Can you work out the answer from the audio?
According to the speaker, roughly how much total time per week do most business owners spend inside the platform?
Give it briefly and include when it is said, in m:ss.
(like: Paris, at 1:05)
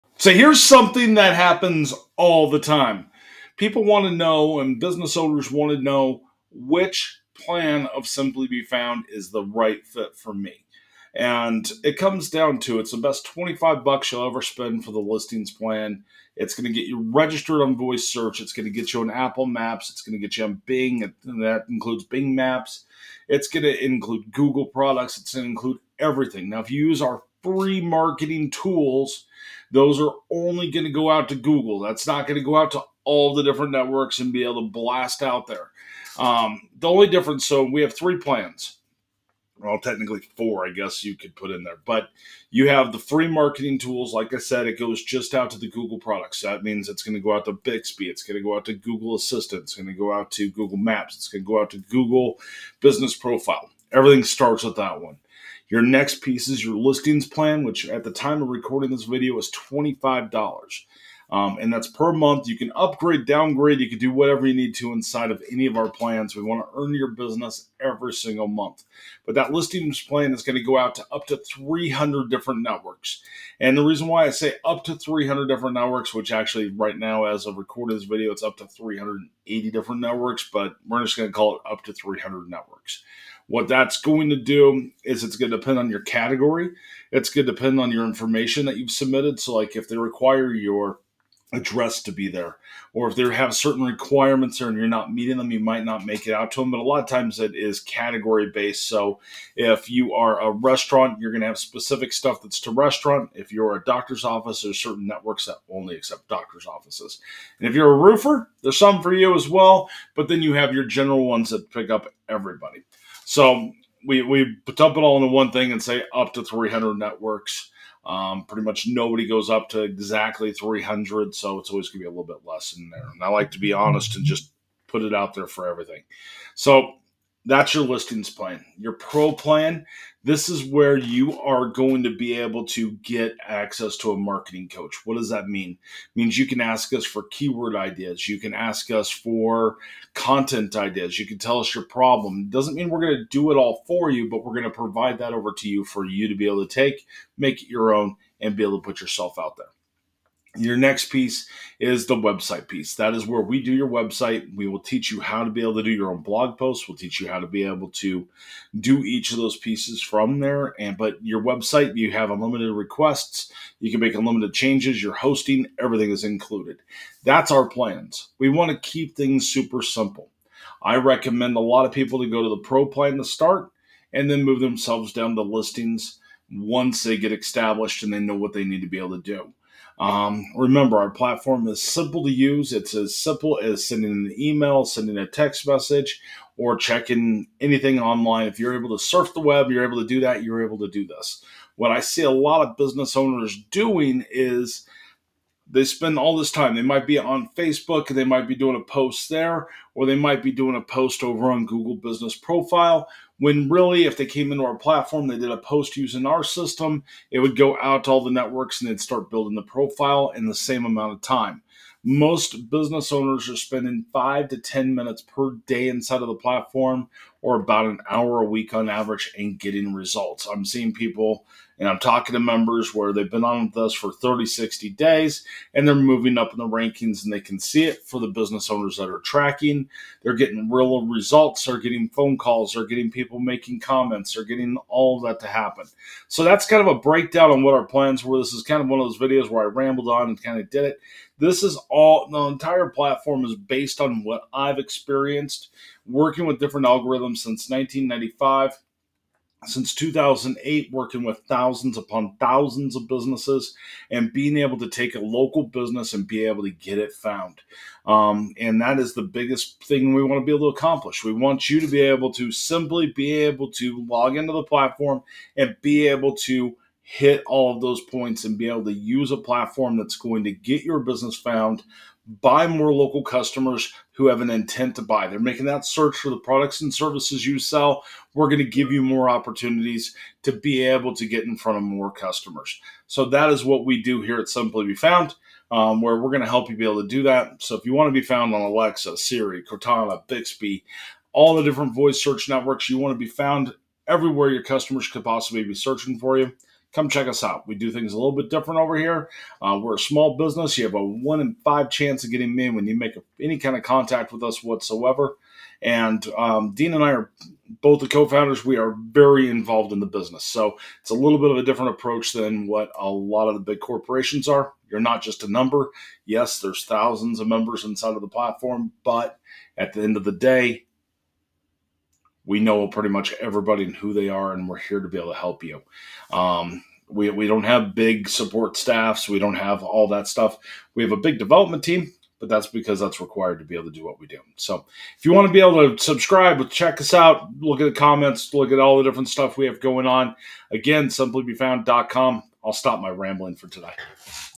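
about an hour, at 3:37.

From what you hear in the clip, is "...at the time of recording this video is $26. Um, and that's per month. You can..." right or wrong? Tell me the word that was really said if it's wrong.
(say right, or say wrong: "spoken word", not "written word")
wrong: "25", not "26".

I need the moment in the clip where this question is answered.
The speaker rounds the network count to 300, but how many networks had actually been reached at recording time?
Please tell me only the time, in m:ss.
1:18.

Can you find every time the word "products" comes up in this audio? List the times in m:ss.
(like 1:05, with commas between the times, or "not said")
0:24, 0:45, 4:36.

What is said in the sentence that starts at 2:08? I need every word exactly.
Your pro plan, this is where you are going to be able to get access to a marketing coach.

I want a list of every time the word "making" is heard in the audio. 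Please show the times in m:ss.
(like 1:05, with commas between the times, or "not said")
3:53, 4:35.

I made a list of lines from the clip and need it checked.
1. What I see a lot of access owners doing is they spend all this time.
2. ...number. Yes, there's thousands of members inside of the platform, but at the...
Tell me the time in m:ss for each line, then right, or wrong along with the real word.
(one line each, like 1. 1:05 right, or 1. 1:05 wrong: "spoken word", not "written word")
1. 3:11 wrong: "business", not "access"
2. 5:15 right.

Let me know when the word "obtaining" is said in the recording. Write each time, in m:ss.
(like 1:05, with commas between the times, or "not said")
not said.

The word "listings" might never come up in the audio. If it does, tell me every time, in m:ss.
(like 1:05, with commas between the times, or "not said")
0:14, 0:56, 1:09, 2:07, 2:55.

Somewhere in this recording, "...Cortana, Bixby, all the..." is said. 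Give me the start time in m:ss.
4:49.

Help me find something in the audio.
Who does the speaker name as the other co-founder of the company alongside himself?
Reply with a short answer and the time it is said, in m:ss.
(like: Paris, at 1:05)
Dean, at 5:06.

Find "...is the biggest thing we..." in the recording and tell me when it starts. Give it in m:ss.
4:18.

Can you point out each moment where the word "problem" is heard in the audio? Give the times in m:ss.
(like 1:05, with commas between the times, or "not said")
2:21.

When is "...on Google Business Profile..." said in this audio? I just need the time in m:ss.
3:21.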